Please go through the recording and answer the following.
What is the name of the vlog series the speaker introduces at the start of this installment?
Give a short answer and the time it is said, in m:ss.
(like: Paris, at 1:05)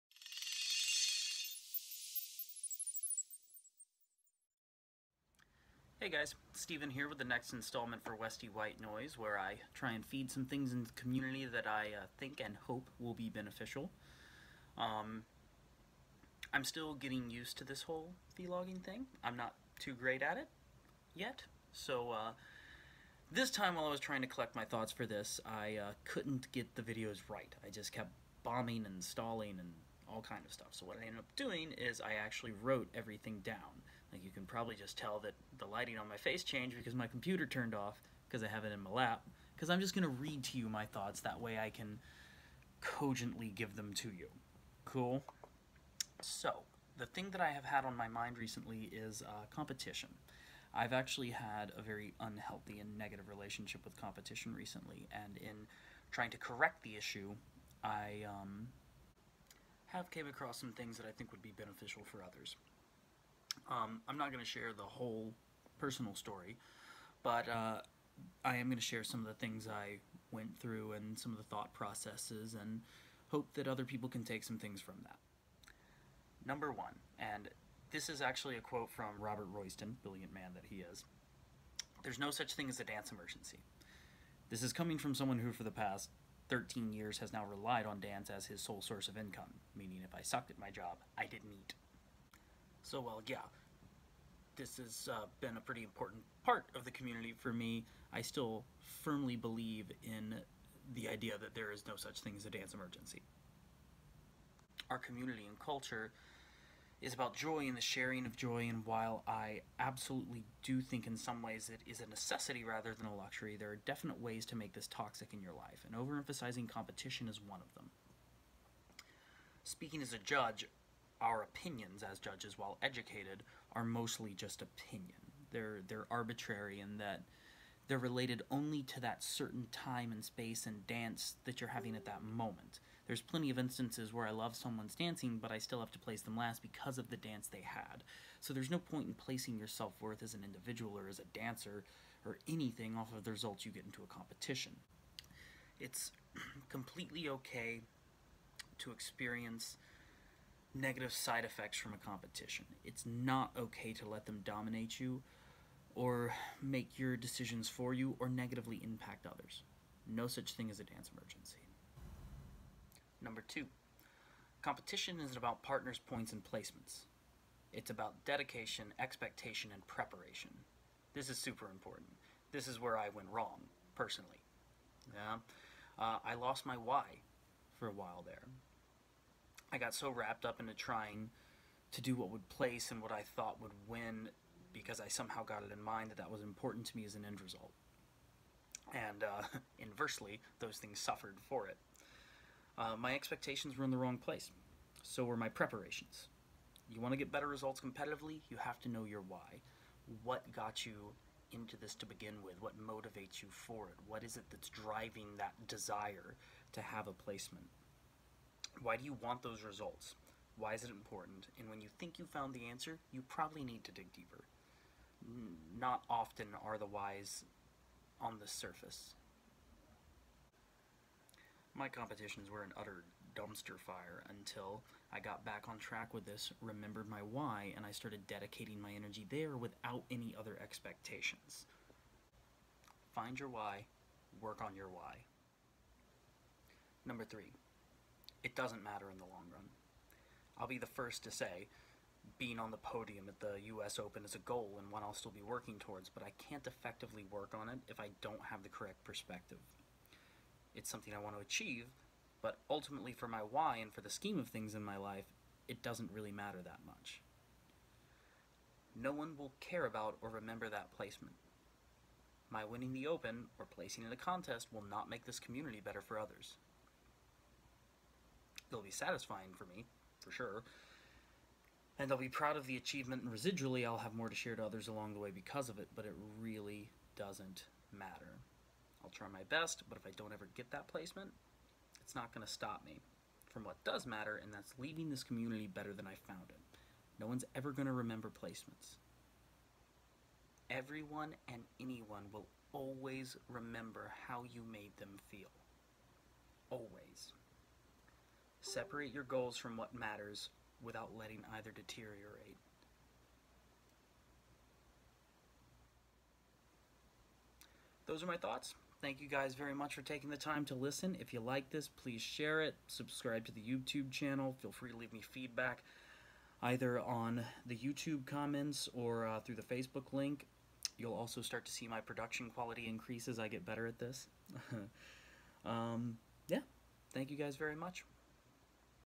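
Westie White Noise, at 0:08.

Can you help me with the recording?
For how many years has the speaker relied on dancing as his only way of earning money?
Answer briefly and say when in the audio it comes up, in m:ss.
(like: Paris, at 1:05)
13, at 1:26.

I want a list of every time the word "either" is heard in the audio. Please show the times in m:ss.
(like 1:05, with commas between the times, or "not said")
5:01, 5:16.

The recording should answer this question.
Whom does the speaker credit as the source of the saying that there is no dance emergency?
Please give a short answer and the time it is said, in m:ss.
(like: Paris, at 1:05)
Robert Royston, at 1:19.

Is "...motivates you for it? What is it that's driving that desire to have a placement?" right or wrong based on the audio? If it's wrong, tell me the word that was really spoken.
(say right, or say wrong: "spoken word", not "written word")
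right.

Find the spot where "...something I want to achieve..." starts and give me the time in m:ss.
4:10.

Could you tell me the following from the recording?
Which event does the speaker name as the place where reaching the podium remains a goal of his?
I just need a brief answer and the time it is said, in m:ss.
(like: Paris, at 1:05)
US Open, at 4:03.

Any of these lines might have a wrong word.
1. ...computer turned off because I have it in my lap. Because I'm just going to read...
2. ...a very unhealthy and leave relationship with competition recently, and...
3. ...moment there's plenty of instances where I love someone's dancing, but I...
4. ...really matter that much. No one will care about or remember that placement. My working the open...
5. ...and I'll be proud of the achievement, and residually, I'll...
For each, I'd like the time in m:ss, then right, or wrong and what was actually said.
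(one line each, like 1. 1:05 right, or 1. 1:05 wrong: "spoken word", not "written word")
1. 0:37 right
2. 0:51 wrong: "negative", not "leave"
3. 2:12 right
4. 4:16 wrong: "winning", not "working"
5. 4:31 right.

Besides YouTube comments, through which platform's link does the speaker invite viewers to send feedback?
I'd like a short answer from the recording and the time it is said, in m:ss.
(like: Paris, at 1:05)
Facebook, at 5:19.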